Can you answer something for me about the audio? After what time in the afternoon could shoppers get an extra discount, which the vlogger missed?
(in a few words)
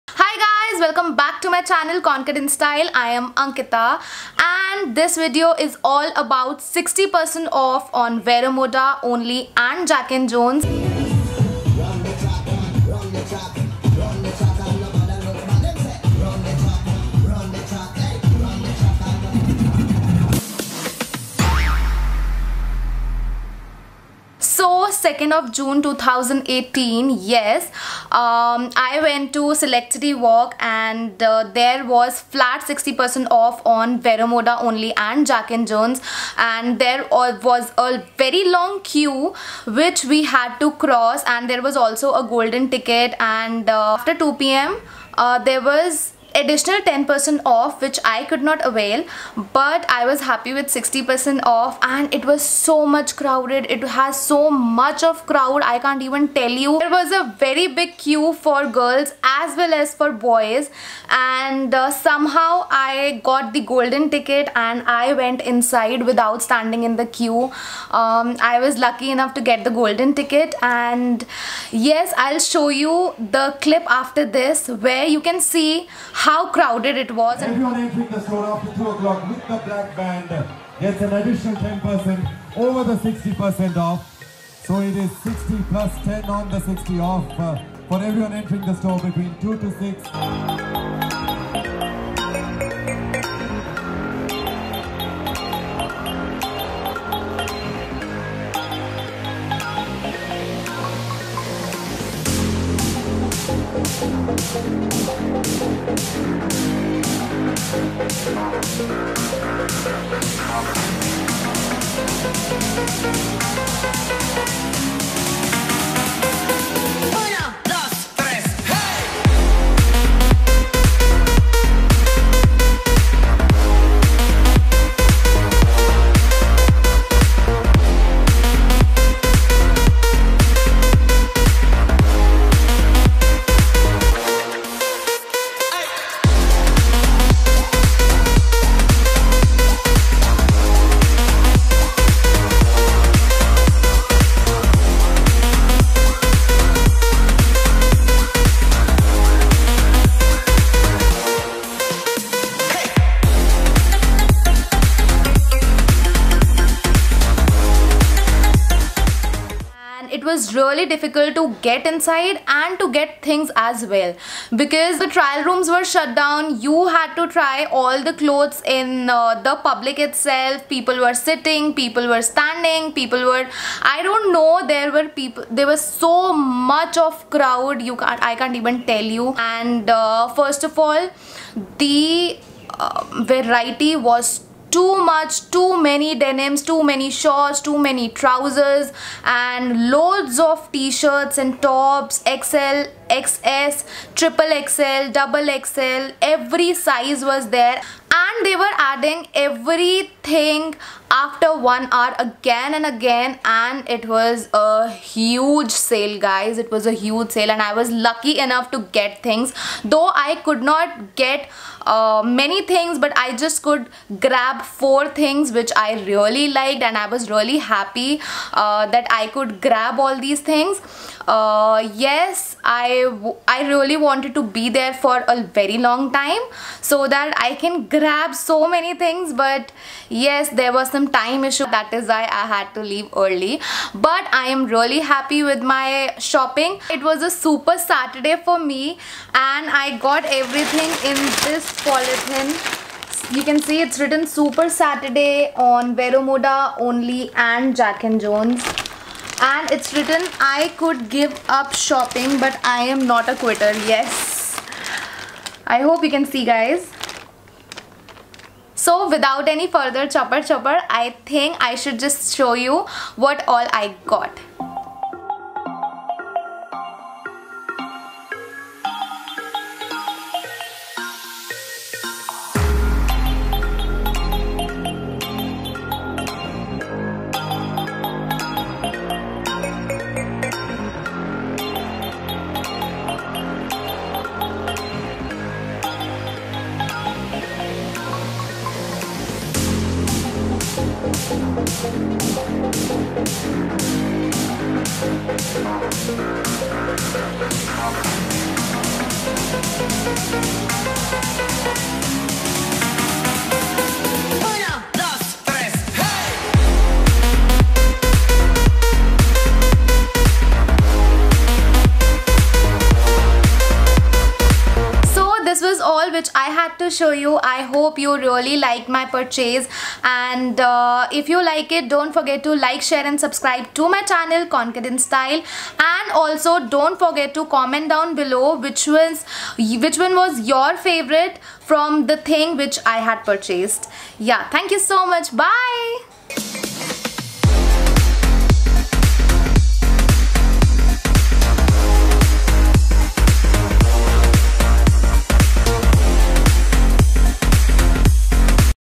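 2 p.m.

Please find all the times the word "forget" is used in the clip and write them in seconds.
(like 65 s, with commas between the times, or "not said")
322 s, 326 s.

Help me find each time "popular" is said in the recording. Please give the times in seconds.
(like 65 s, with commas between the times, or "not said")
not said.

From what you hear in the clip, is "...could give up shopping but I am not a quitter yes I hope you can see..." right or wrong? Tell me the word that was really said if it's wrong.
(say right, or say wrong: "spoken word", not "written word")
right.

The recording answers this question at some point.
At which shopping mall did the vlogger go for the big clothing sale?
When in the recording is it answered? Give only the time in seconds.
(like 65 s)
29 s.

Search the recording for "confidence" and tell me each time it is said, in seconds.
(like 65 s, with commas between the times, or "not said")
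324 s.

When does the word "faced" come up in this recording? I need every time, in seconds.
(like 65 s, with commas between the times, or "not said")
not said.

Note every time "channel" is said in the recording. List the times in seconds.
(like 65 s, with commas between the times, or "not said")
1 s, 324 s.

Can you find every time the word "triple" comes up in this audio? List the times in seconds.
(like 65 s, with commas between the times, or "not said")
194 s.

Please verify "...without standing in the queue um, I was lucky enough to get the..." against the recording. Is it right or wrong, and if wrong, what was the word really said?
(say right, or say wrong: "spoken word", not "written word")
right.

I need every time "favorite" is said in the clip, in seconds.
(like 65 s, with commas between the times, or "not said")
330 s.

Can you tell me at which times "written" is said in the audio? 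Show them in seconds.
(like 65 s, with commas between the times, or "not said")
243 s, 249 s.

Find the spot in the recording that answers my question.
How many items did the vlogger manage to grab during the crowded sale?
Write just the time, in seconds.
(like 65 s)
214 s.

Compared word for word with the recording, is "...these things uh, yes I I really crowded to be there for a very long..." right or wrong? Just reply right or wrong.
wrong.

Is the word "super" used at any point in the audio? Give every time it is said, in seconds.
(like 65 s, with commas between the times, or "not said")
237 s, 244 s.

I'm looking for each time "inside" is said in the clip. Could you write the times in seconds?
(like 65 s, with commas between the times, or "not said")
65 s, 161 s.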